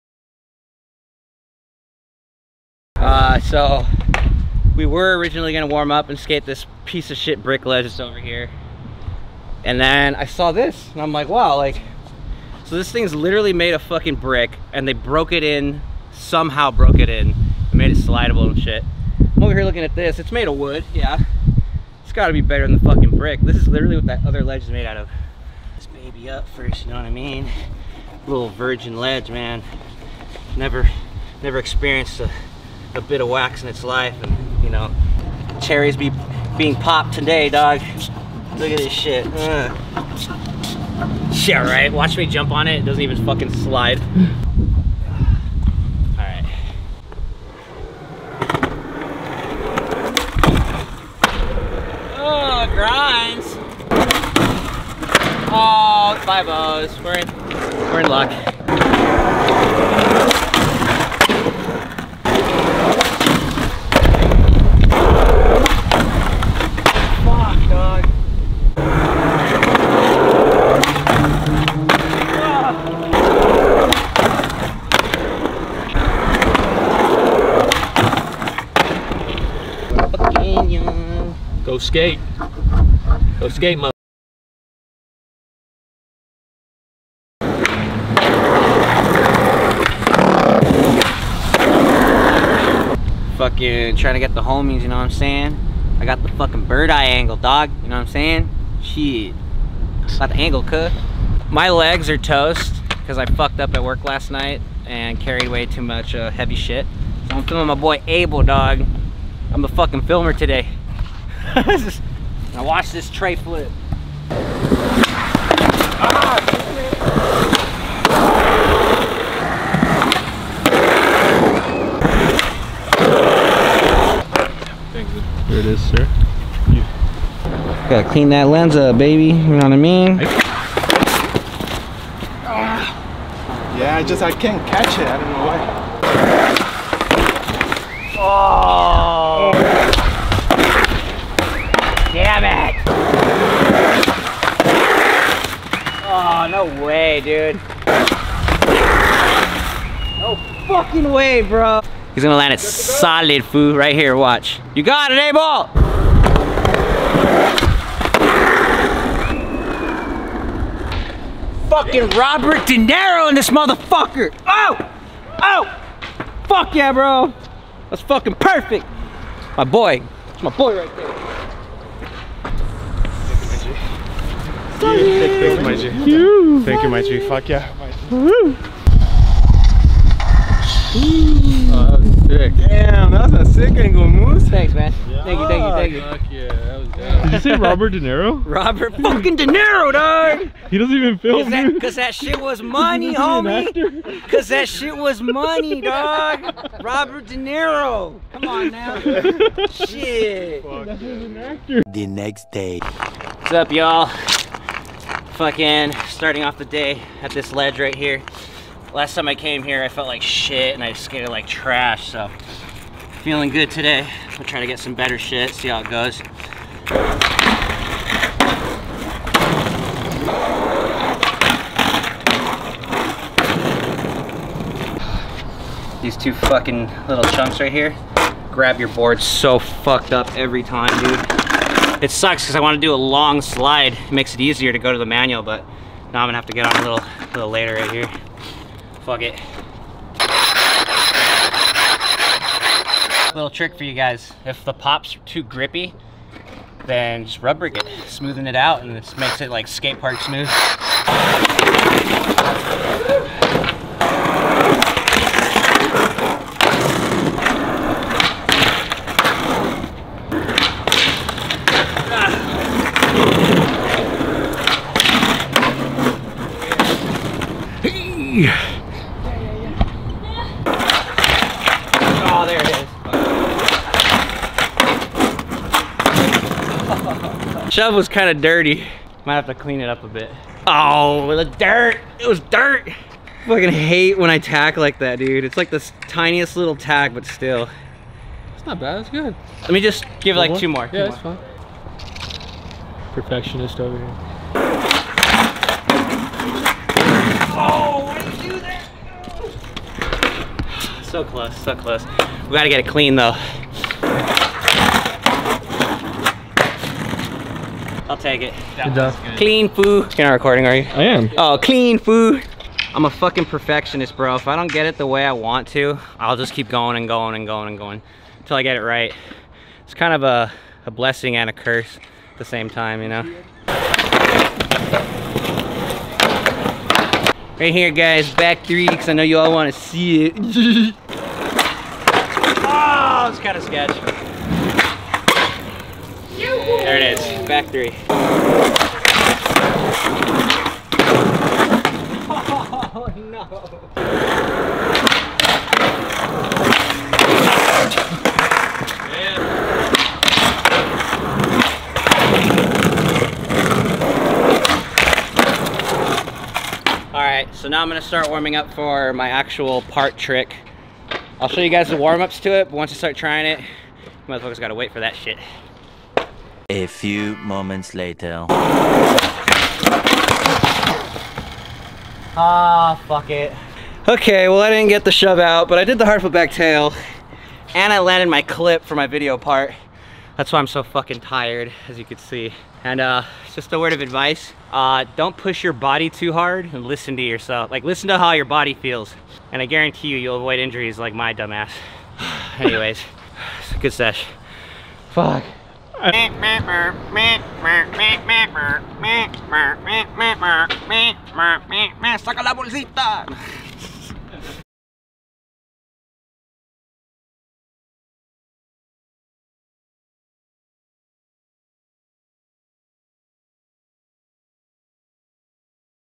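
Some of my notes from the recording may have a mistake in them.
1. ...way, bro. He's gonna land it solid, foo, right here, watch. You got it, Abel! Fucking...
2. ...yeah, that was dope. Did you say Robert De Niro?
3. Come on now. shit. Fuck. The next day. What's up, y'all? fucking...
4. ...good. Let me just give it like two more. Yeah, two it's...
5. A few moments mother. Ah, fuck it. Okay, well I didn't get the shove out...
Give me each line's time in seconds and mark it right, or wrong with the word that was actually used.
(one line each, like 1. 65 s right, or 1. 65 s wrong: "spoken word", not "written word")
1. 151 s right
2. 186 s right
3. 198 s right
4. 289 s right
5. 366 s wrong: "later", not "mother".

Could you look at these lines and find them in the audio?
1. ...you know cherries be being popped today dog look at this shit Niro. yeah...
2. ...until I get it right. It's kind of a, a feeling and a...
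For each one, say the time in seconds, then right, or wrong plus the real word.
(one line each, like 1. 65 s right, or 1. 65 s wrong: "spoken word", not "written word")
1. 34 s wrong: "Ugh", not "Niro"
2. 318 s wrong: "blessing", not "feeling".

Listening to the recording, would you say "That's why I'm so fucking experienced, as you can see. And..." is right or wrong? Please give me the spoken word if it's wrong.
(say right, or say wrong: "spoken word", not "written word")
wrong: "tired", not "experienced".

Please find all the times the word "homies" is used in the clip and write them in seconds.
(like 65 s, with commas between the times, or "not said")
94 s, 193 s.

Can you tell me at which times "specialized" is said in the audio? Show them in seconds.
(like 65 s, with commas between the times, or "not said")
not said.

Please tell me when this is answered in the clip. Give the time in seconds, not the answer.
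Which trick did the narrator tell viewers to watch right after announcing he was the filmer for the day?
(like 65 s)
113 s.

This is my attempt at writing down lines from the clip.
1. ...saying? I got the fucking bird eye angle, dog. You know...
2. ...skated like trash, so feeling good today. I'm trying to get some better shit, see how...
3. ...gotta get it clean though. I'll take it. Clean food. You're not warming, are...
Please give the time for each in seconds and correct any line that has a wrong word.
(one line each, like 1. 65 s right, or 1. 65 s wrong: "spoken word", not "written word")
1. 95 s right
2. 210 s right
3. 302 s wrong: "recording", not "warming".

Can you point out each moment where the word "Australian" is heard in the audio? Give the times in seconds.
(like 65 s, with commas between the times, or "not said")
not said.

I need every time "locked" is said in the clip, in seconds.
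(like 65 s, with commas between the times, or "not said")
not said.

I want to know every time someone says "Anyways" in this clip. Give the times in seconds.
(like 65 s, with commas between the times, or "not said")
392 s.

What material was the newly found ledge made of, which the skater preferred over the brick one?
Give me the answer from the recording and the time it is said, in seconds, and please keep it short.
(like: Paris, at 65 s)
wood, at 20 s.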